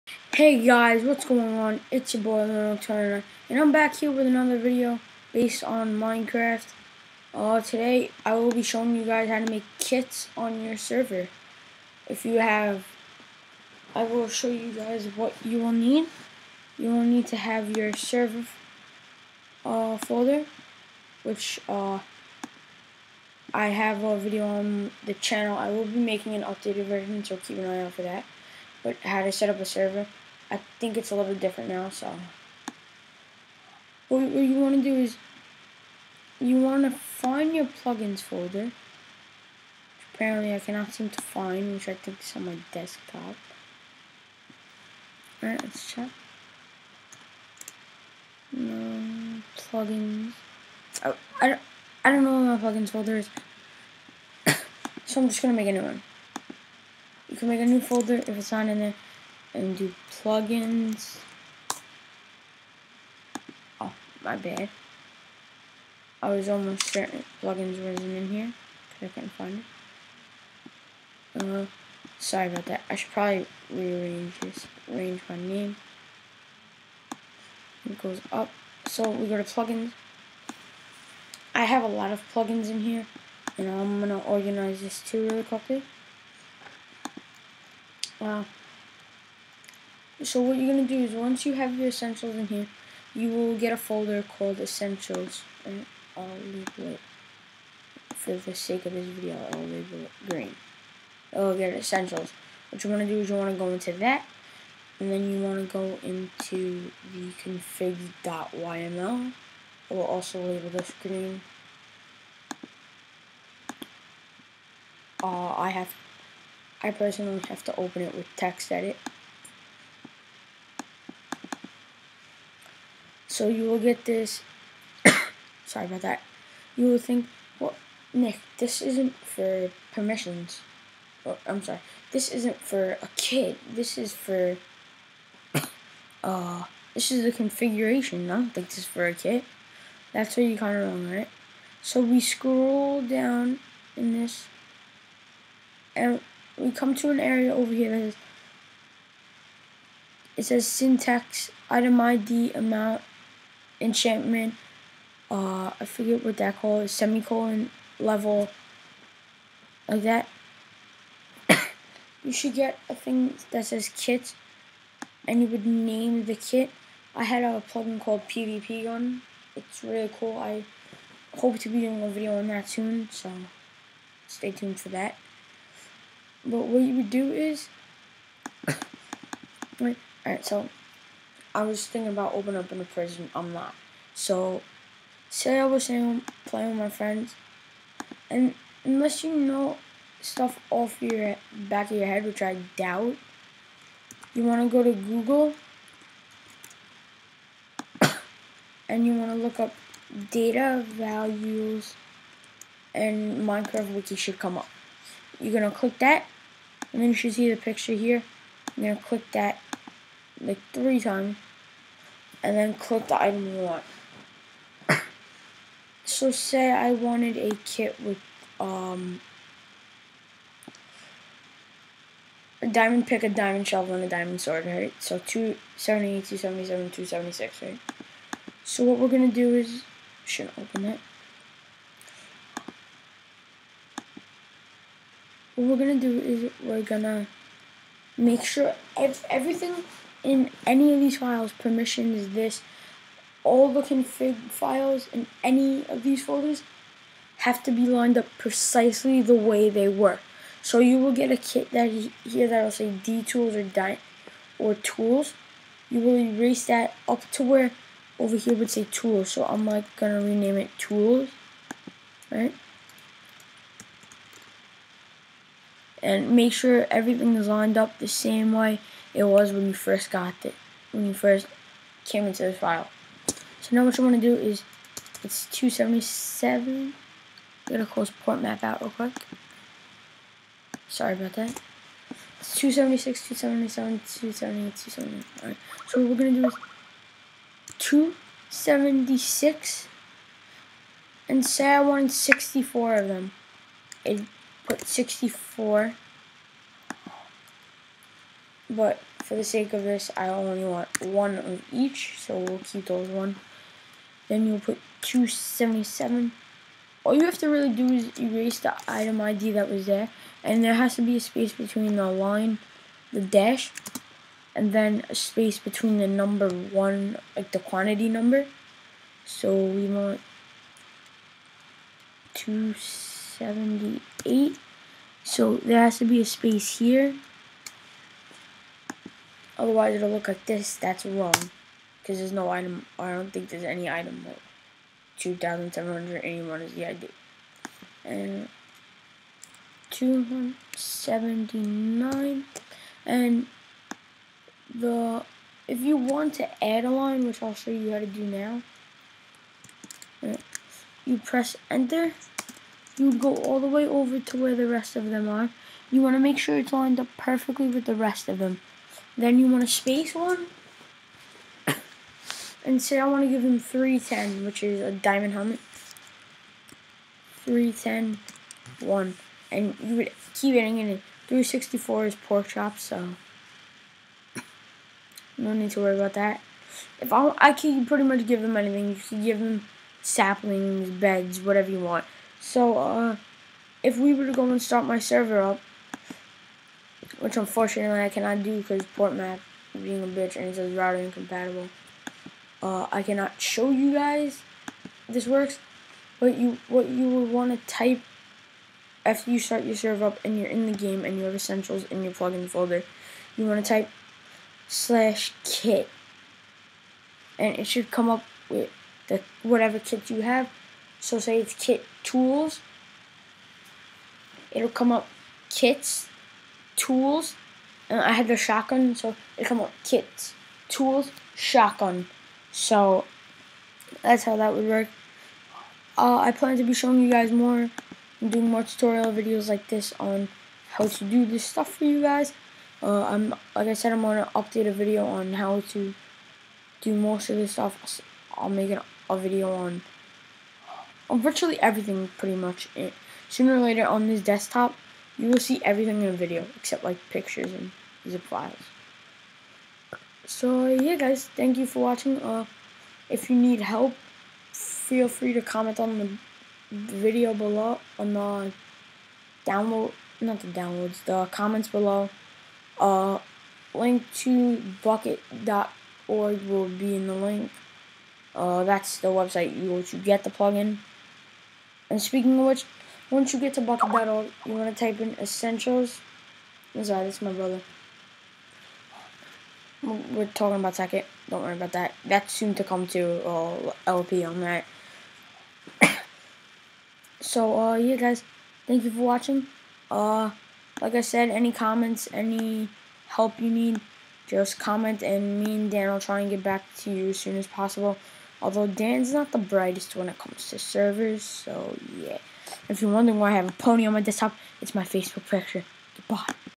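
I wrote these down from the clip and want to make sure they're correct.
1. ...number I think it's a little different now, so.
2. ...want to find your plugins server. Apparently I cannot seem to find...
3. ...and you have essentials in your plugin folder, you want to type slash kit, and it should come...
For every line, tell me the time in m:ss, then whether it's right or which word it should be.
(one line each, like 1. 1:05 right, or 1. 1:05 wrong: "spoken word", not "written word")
1. 0:29 wrong: "server", not "number"
2. 0:36 wrong: "folder", not "server"
3. 6:41 right.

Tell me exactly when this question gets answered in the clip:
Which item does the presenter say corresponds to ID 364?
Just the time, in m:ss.
6:12.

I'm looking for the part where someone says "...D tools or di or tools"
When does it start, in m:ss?
4:12.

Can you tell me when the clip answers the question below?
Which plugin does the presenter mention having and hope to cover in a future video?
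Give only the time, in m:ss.
2:48.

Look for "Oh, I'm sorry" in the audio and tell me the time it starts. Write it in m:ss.
2:11.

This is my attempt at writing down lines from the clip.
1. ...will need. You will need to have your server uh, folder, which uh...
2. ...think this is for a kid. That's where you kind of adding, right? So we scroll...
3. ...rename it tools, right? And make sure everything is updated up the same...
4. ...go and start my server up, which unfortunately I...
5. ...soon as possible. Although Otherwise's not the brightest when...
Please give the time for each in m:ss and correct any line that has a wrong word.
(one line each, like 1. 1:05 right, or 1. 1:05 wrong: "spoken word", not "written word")
1. 0:15 right
2. 2:18 wrong: "wrong", not "adding"
3. 4:20 wrong: "lined", not "updated"
4. 6:24 right
5. 8:17 wrong: "Dan", not "Otherwise".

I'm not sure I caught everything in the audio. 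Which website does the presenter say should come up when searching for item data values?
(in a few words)
Minecraft Wiki.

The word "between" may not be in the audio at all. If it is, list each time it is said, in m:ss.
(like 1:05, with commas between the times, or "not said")
5:11, 5:15.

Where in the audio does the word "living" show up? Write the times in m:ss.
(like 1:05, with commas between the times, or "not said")
not said.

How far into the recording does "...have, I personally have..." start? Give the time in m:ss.
1:55.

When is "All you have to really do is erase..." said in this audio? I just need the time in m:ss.
5:07.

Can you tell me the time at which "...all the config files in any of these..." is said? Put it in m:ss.
4:03.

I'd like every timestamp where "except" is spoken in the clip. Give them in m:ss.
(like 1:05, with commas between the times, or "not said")
7:26.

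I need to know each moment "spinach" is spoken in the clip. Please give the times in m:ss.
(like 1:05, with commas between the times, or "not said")
not said.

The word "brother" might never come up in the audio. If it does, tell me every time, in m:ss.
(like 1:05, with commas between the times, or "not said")
7:57.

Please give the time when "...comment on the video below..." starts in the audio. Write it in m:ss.
7:35.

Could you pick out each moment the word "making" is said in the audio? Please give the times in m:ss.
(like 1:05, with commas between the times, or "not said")
0:25.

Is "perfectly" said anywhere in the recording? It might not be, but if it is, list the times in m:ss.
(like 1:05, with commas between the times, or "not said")
5:57.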